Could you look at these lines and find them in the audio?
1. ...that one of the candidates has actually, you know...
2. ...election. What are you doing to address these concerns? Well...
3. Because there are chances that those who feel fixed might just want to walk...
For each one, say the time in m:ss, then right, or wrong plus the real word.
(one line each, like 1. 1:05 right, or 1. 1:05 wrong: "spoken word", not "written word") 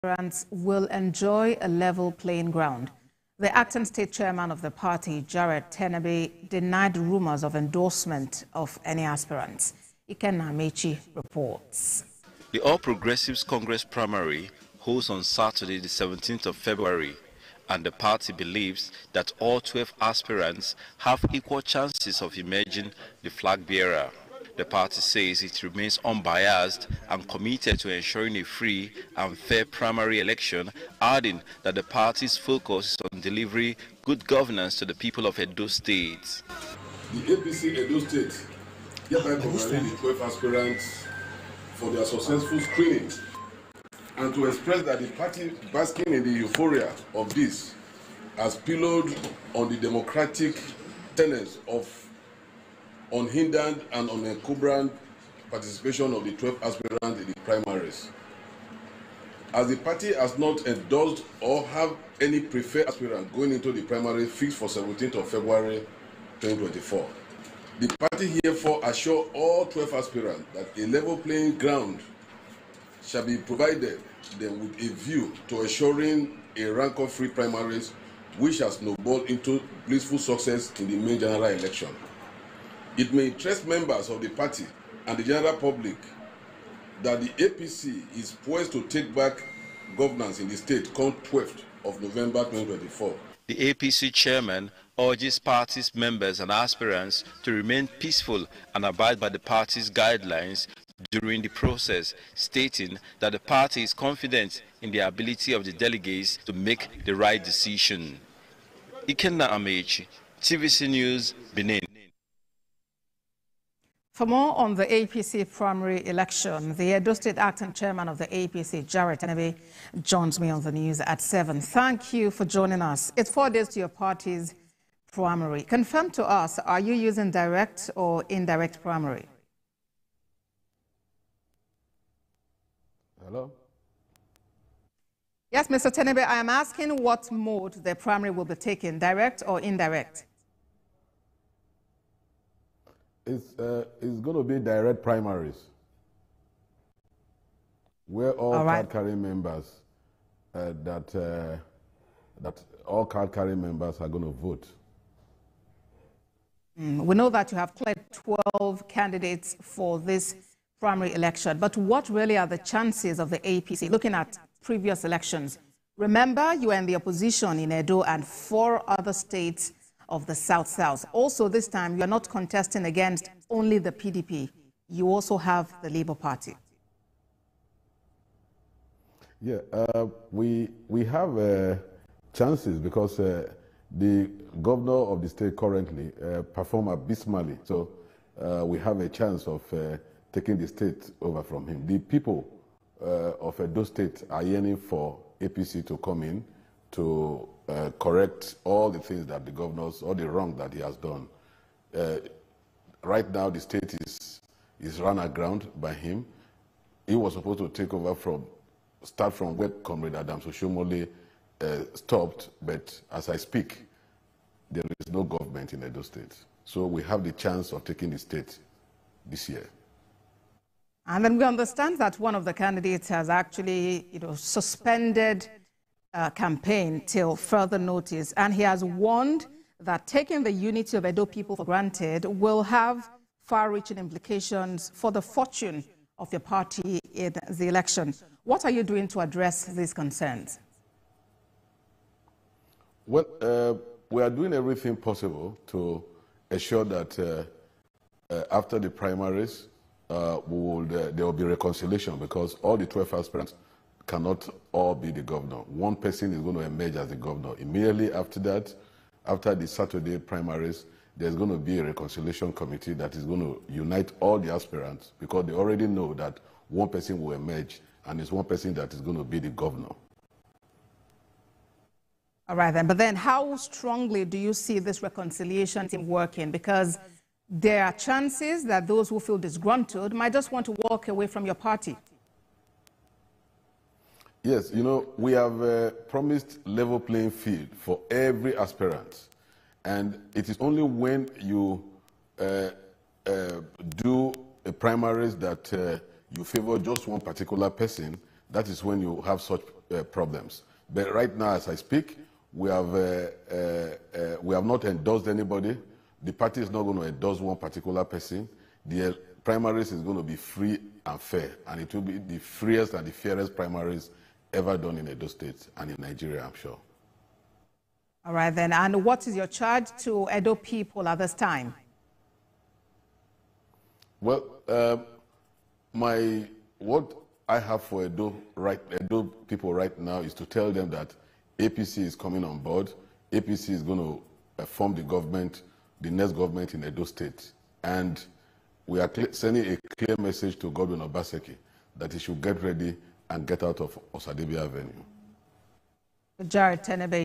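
1. 3:41 right
2. 3:57 right
3. 4:36 wrong: "disgruntled", not "fixed".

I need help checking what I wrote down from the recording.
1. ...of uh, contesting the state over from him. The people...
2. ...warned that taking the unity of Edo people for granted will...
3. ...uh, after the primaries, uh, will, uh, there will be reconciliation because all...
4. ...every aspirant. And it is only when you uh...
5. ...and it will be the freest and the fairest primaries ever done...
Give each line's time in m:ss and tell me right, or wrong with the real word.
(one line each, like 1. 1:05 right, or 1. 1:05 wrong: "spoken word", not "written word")
1. 3:09 wrong: "taking", not "contesting"
2. 3:48 right
3. 4:08 right
4. 4:48 right
5. 5:11 right.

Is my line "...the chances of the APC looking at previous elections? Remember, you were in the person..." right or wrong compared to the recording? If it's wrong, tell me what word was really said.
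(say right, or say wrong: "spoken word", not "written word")
wrong: "opposition", not "person".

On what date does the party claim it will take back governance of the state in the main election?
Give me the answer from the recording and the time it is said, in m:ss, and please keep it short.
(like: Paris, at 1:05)
12th of November 2024, at 1:31.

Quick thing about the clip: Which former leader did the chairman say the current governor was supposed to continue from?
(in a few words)
Adams Oshiomhole.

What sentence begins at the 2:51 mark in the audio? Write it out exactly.
Also, this time, you are not contesting against only the PDP.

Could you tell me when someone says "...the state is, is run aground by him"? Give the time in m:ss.
3:23.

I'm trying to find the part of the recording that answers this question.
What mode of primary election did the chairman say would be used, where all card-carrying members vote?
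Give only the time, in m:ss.
2:24.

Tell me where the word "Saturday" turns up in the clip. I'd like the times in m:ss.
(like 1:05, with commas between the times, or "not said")
0:15, 4:19.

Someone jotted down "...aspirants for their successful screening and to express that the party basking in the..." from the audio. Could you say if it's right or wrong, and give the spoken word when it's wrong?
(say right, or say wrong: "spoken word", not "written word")
right.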